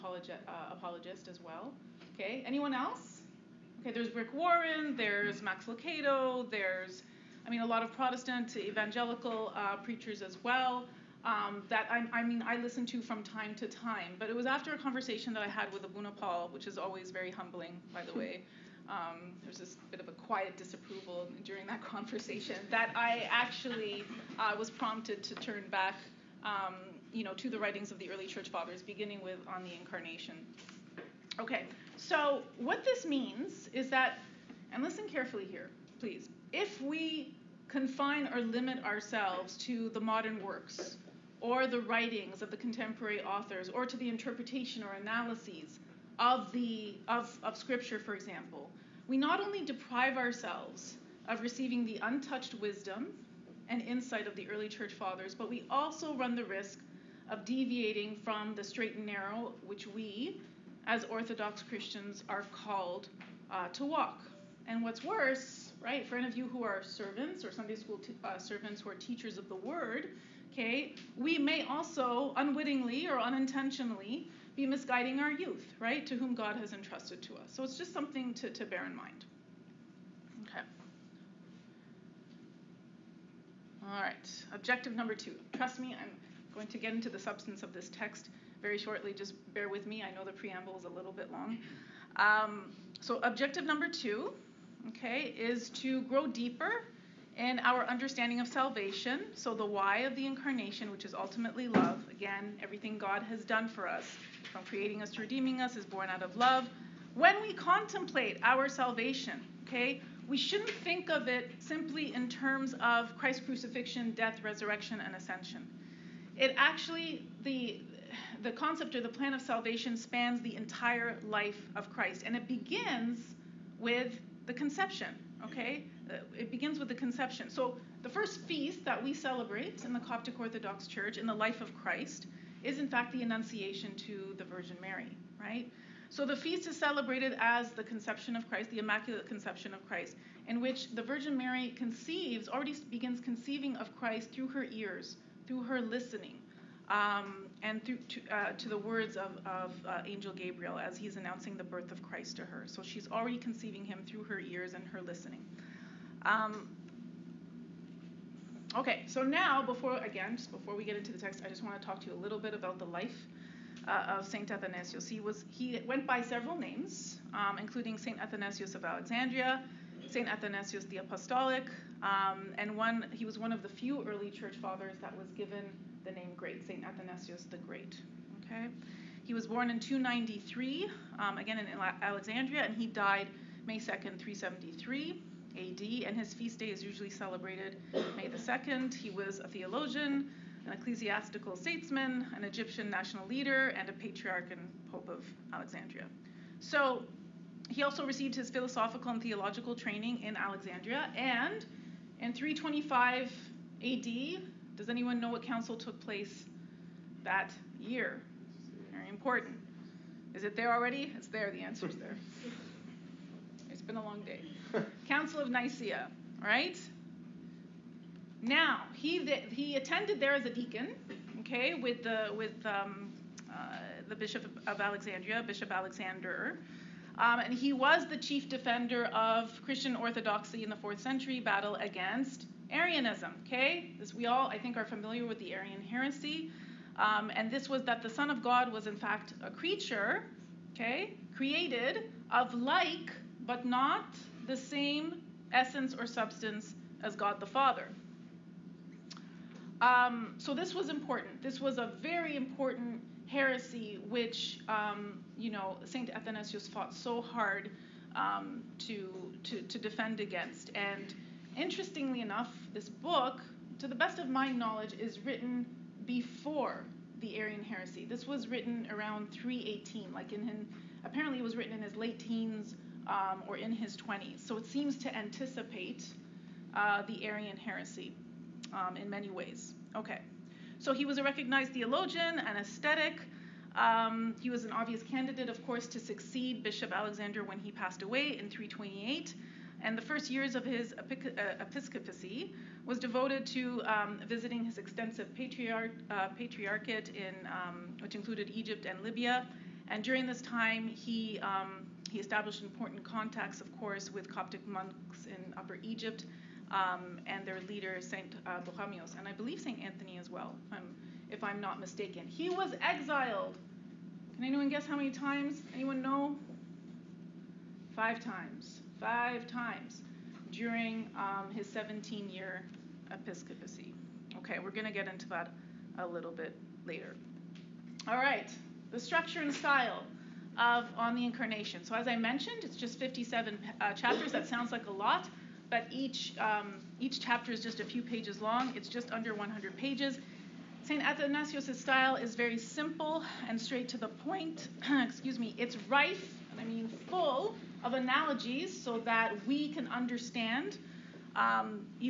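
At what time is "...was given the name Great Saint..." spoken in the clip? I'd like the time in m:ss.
2:55.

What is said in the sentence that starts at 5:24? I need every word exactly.
Okay, we're going to get into that a little bit later.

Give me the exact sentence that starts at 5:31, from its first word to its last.
So as I mentioned, it's just 57 uh, chapters.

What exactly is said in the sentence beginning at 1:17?
So it's just something to, to bear in mind.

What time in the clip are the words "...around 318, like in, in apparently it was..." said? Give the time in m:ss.
4:28.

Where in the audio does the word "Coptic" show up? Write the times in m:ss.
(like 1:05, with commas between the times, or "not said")
2:09, 5:04.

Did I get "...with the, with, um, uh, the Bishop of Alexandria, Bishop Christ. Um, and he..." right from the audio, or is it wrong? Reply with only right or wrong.
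wrong.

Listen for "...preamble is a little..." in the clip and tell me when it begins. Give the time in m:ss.
1:30.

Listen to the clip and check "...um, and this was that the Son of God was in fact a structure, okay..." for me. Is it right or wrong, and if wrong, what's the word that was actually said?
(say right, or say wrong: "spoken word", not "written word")
wrong: "creature", not "structure".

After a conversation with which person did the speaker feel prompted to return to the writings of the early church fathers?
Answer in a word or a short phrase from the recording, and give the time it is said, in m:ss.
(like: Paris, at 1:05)
Abuna Paul, at 0:15.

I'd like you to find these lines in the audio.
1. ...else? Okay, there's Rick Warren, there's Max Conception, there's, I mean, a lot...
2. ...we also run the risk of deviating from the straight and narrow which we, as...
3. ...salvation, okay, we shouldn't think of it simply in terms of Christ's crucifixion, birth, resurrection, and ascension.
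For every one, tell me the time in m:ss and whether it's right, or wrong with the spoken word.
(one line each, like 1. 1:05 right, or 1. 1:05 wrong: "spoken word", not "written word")
1. 0:02 wrong: "Lucado", not "Conception"
2. 0:55 right
3. 1:48 wrong: "death", not "birth".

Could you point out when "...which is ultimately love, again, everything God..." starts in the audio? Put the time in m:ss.
1:40.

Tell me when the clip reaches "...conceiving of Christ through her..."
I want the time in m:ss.
2:23.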